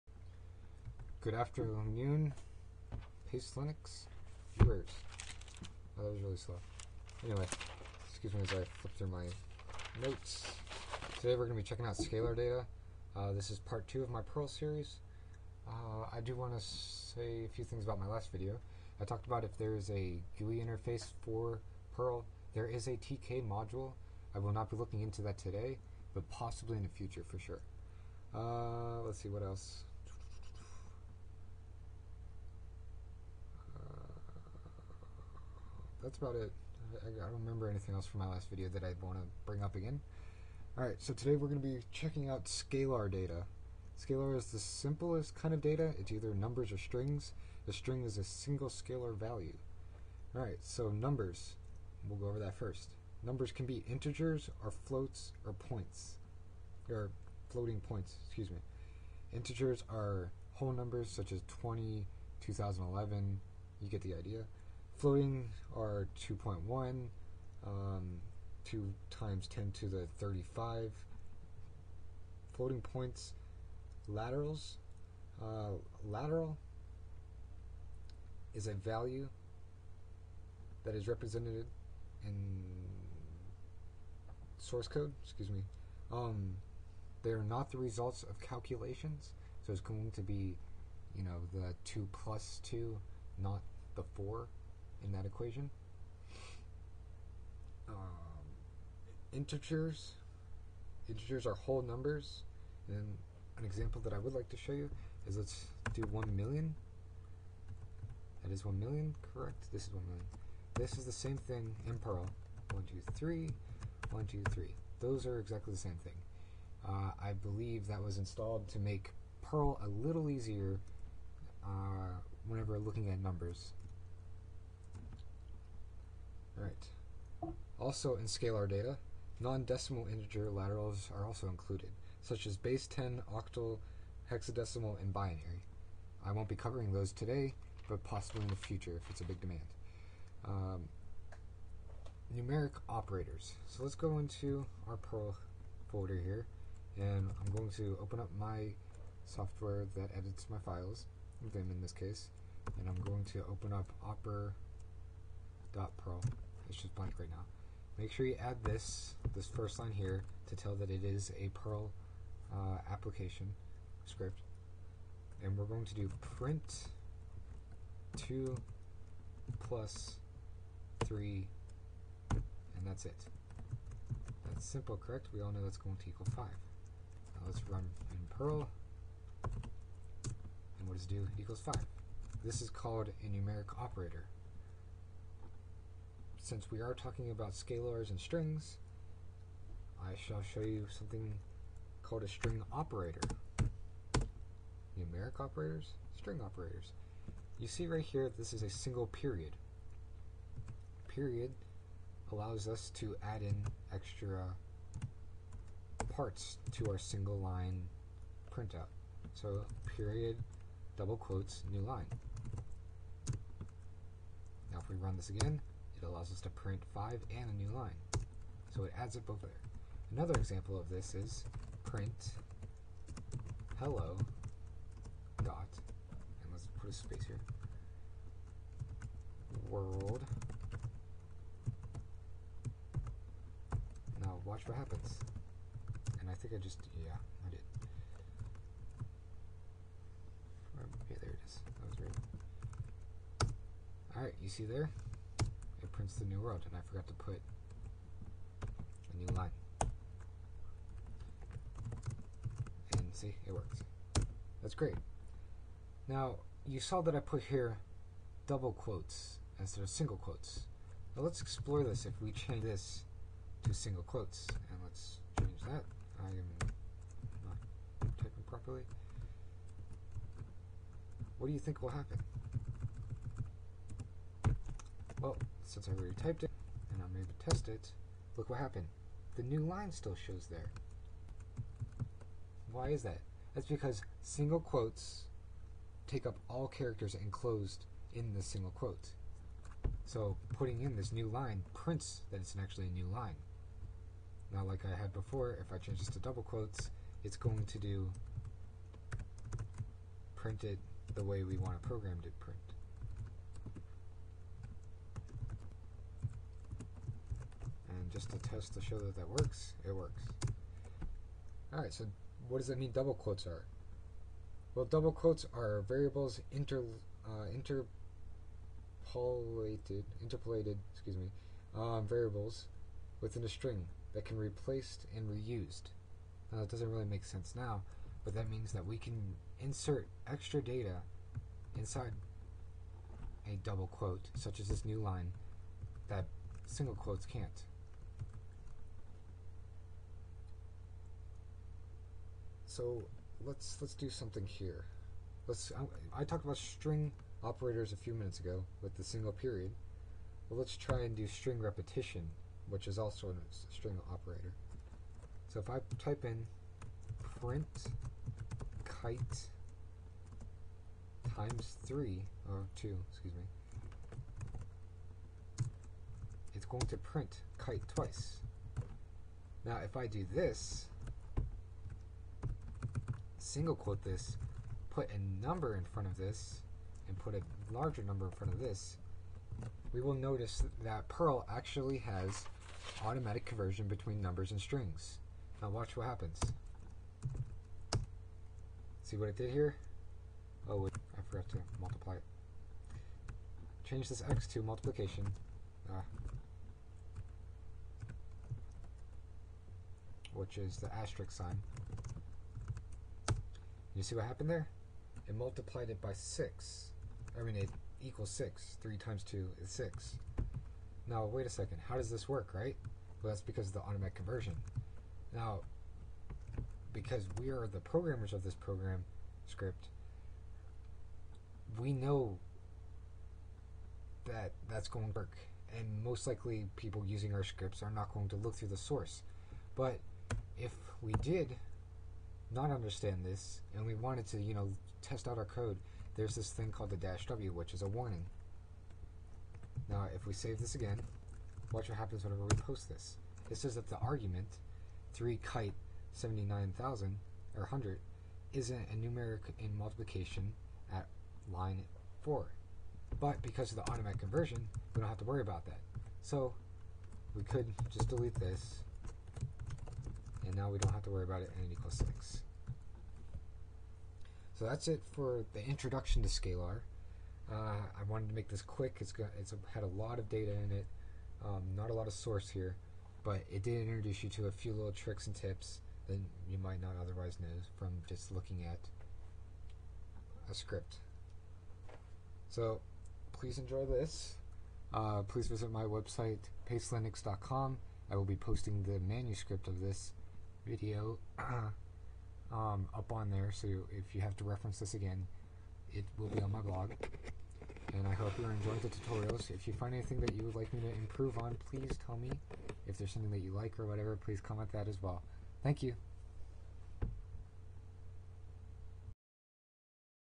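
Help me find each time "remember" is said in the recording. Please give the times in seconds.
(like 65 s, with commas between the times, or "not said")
37 s.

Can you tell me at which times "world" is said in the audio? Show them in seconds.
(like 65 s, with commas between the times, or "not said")
229 s, 246 s.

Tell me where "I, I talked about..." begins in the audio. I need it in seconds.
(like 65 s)
346 s.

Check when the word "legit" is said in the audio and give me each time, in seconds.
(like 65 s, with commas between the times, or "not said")
not said.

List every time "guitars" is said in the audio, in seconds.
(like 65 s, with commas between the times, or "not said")
not said.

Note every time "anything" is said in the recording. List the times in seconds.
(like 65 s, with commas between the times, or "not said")
37 s, 499 s.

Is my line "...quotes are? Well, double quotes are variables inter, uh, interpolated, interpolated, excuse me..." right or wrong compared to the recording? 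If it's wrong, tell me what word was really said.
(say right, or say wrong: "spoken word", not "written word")
right.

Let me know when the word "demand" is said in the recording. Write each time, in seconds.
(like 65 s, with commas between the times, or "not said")
139 s.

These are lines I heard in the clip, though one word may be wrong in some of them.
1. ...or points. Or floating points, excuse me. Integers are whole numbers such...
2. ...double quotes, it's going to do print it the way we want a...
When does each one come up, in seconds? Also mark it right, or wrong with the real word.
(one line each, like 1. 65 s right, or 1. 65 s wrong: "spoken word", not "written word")
1. 55 s right
2. 296 s right.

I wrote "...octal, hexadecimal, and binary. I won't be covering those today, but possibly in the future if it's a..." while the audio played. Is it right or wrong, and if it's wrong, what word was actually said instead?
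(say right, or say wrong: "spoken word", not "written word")
right.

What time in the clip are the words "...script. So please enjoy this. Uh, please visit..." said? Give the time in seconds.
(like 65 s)
480 s.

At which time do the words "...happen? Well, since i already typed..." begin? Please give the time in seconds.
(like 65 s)
271 s.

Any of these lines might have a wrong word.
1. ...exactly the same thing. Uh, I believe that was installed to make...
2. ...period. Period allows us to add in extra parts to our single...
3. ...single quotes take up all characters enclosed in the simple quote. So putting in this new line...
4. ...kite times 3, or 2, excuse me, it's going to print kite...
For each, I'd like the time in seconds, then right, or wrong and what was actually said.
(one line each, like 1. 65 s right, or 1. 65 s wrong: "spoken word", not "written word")
1. 115 s right
2. 199 s right
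3. 284 s wrong: "single", not "simple"
4. 358 s right.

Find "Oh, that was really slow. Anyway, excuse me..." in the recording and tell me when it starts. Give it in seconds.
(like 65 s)
5 s.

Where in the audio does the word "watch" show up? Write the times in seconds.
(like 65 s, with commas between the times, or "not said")
234 s, 385 s, 441 s.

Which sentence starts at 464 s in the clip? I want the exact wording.
So that's it for the introduction to scalar.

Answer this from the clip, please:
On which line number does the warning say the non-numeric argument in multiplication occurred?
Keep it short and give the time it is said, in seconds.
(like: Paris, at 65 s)
4, at 451 s.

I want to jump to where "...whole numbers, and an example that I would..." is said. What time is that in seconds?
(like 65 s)
101 s.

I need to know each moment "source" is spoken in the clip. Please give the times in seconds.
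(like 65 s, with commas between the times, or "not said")
84 s, 428 s, 472 s.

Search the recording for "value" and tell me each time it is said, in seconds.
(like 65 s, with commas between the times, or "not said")
49 s, 78 s.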